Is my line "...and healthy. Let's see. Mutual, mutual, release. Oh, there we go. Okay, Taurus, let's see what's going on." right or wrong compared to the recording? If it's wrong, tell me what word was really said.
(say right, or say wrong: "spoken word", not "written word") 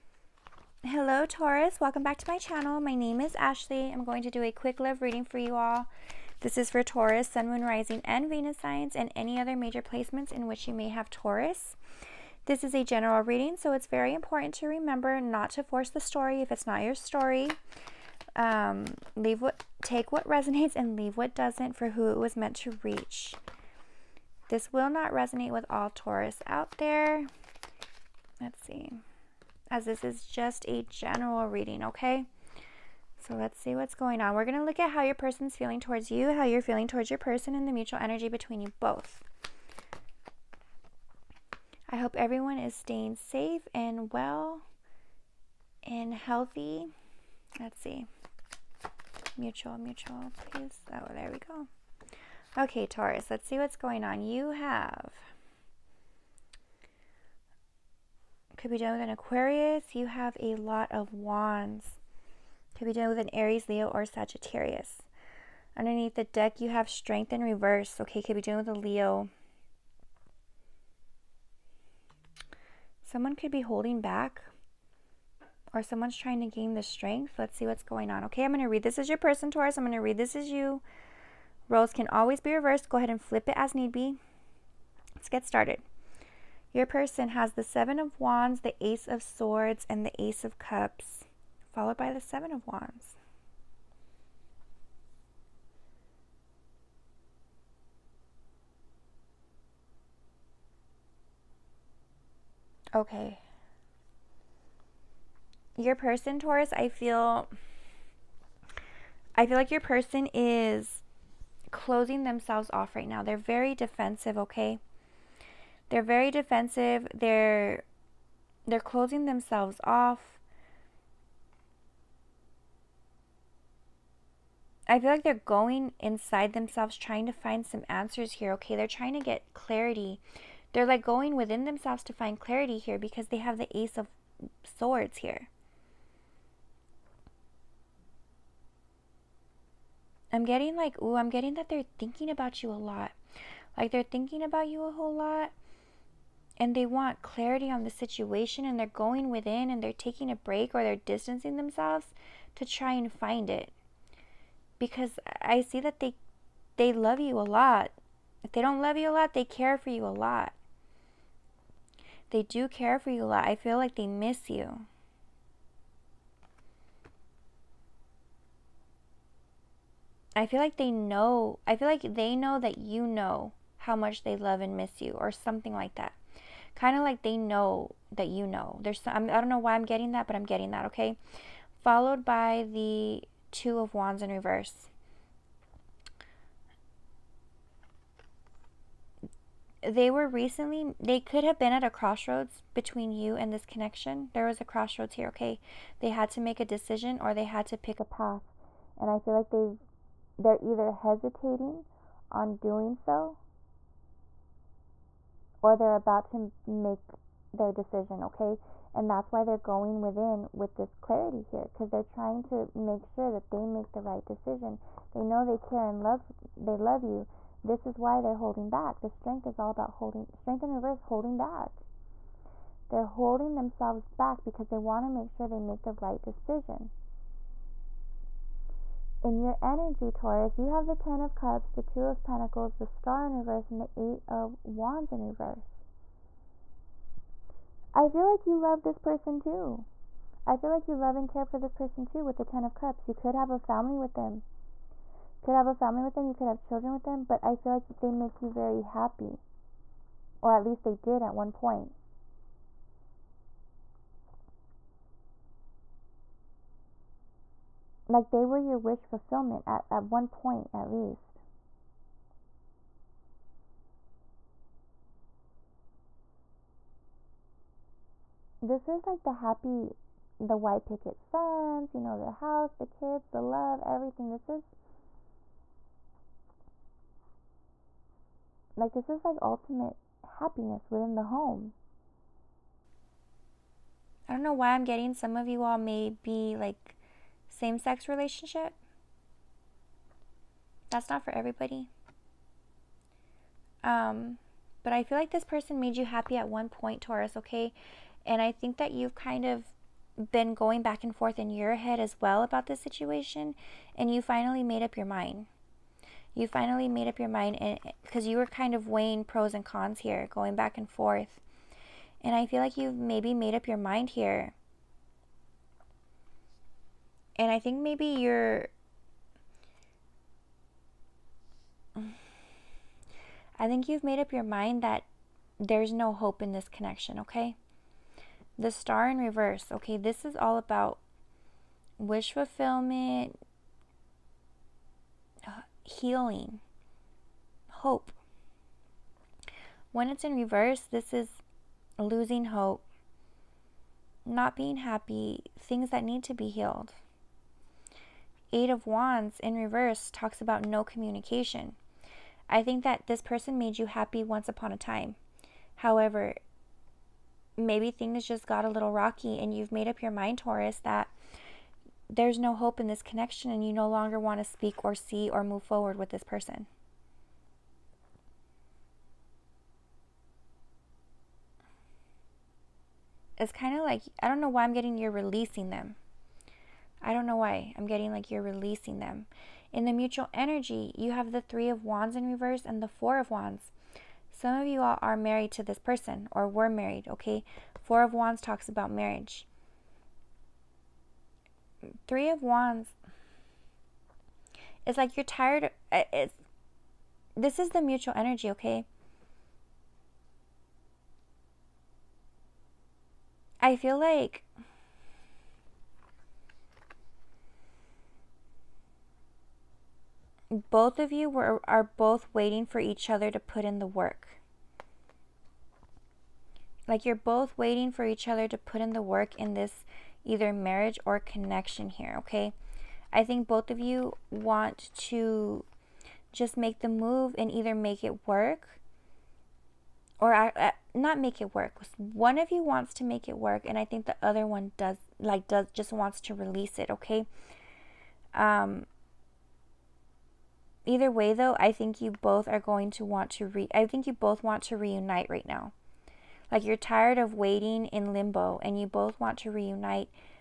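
wrong: "please", not "release".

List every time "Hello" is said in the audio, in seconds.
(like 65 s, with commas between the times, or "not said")
0 s.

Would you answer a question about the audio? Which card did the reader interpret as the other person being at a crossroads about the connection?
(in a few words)
2 of Wands.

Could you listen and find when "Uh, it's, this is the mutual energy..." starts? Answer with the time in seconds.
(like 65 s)
395 s.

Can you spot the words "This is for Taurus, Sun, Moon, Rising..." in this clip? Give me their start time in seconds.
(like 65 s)
6 s.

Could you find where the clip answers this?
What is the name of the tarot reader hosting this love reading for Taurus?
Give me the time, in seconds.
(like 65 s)
3 s.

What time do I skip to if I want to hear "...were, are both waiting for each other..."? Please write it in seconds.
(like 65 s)
411 s.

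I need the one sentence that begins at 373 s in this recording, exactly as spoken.
It's kind of like, I don't know why I'm getting you're releasing them.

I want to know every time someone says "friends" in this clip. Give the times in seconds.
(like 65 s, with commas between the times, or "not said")
not said.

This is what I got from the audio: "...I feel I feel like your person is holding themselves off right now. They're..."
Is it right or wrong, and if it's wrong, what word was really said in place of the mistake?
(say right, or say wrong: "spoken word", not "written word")
wrong: "closing", not "holding".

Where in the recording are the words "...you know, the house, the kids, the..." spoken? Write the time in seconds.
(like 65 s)
271 s.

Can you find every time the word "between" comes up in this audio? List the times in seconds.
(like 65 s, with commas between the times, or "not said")
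38 s, 192 s.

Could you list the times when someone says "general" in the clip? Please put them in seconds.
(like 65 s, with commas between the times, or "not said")
12 s, 30 s.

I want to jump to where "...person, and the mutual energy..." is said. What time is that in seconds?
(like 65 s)
37 s.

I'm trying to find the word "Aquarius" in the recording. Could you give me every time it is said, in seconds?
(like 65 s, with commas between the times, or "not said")
59 s.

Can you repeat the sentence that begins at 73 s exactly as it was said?
Someone could be holding back or someone's trying to gain the strength.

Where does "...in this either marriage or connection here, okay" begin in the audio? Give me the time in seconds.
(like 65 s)
419 s.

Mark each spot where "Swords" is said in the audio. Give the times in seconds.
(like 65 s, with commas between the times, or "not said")
89 s, 134 s.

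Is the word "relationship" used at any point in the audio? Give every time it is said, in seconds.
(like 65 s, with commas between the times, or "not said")
288 s.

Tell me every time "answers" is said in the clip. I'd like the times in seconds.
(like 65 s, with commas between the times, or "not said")
127 s.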